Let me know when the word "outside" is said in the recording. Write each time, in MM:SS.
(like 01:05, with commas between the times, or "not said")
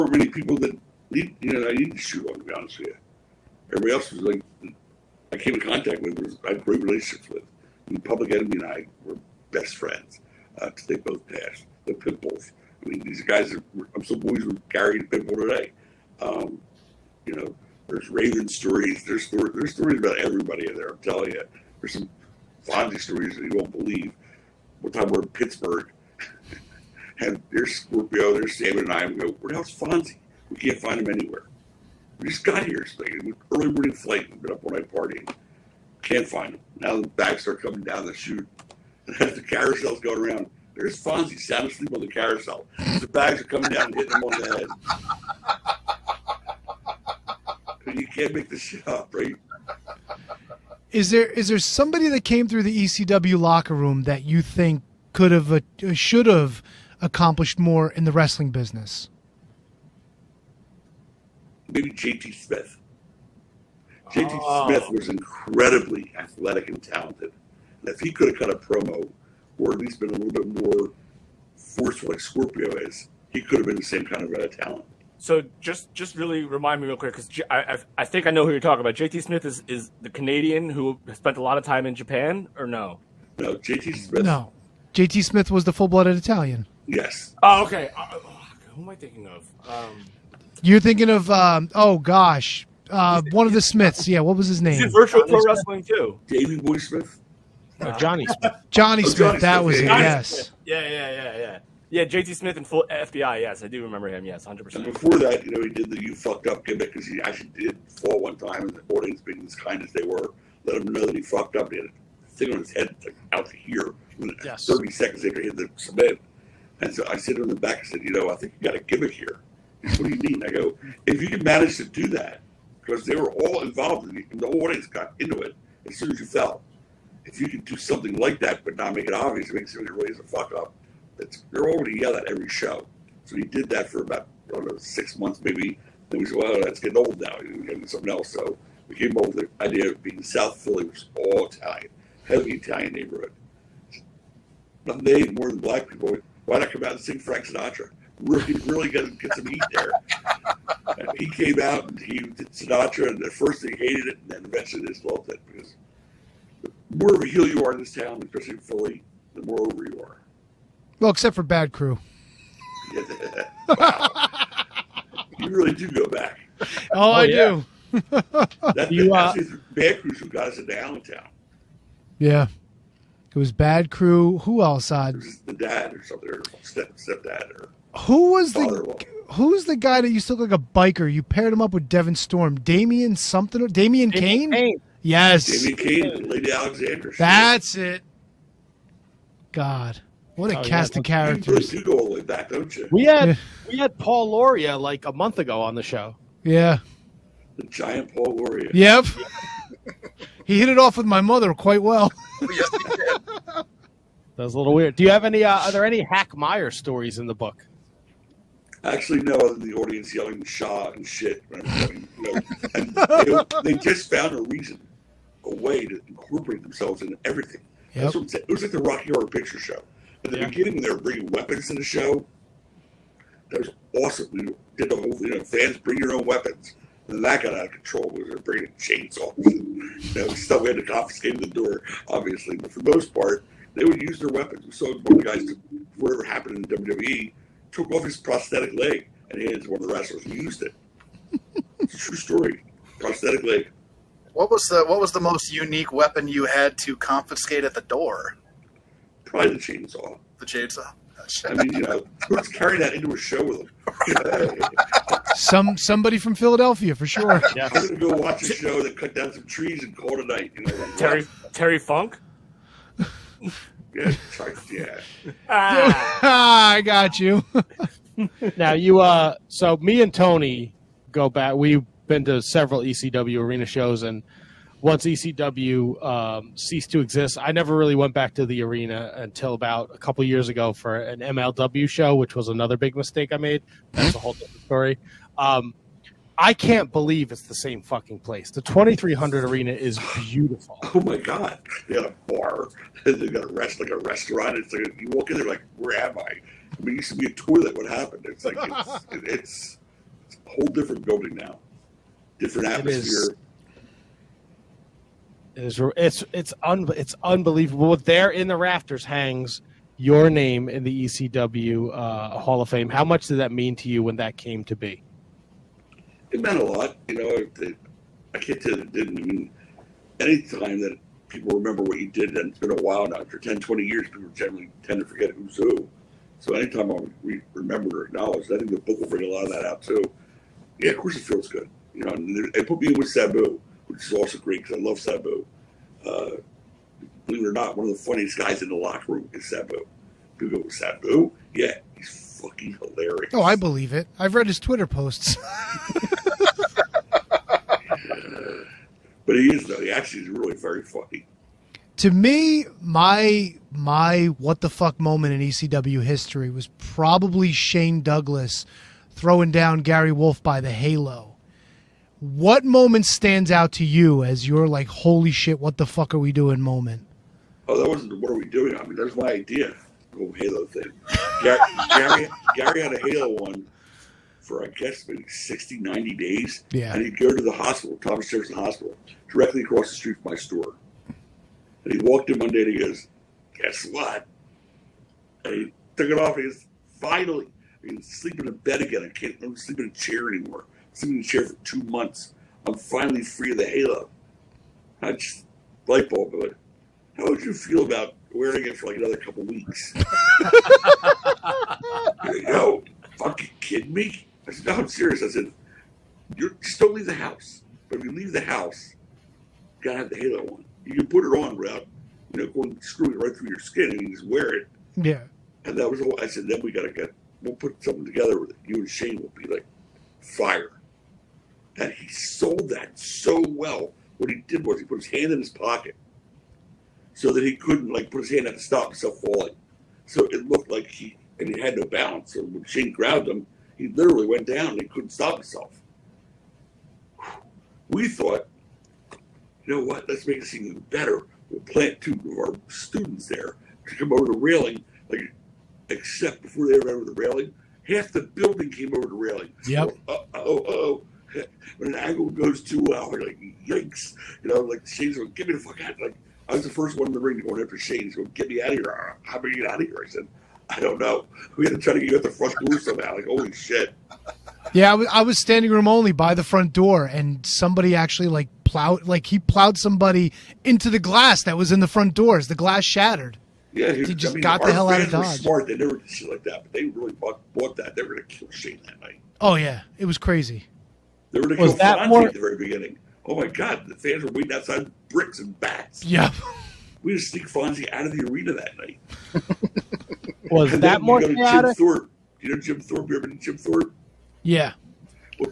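08:04.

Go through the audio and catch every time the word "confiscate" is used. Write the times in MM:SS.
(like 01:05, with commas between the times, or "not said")
03:50, 04:06.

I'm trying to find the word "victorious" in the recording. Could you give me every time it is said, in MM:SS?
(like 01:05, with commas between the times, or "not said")
not said.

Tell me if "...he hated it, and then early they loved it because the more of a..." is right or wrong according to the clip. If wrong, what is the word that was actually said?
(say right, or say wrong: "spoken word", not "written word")
wrong: "eventually", not "early".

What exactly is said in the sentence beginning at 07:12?
So when Shane grabbed him, he literally went down and he couldn't stop himself.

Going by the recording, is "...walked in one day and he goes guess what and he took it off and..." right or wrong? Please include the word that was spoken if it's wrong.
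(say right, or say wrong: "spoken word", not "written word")
right.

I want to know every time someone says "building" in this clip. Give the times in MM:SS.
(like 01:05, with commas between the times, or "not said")
05:01, 07:28.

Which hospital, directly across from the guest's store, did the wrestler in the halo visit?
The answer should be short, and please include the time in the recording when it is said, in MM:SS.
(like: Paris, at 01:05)
Thomas Jefferson Hospital, at 06:17.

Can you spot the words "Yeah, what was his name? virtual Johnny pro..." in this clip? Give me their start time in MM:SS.
01:34.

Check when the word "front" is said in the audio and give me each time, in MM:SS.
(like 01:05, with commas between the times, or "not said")
07:42, 07:46, 07:51.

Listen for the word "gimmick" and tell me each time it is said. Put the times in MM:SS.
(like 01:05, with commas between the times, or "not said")
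01:46, 01:58.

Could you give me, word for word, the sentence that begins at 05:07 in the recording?
There in the rafters hangs your name in the ECW uh, Hall of Fame.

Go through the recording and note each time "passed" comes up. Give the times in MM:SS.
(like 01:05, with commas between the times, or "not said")
00:11.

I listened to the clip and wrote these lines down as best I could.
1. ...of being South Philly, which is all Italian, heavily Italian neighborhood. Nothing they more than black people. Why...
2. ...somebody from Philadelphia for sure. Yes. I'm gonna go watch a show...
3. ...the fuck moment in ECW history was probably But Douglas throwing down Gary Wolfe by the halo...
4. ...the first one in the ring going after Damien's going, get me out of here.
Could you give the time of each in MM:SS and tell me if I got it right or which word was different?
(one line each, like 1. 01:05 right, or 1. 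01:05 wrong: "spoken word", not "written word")
1. 02:19 right
2. 04:15 right
3. 05:54 wrong: "Shane", not "But"
4. 07:36 wrong: "Shane", not "Damien".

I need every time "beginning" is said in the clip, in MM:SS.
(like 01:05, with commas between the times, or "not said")
03:40, 08:02.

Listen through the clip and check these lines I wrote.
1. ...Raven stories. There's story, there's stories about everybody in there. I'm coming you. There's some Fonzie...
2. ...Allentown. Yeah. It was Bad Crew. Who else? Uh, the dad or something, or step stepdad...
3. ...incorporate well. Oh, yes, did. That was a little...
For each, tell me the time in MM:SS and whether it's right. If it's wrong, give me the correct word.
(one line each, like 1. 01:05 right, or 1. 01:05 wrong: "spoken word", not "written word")
1. 00:18 wrong: "telling", not "coming"
2. 02:50 right
3. 03:21 wrong: "quite", not "incorporate".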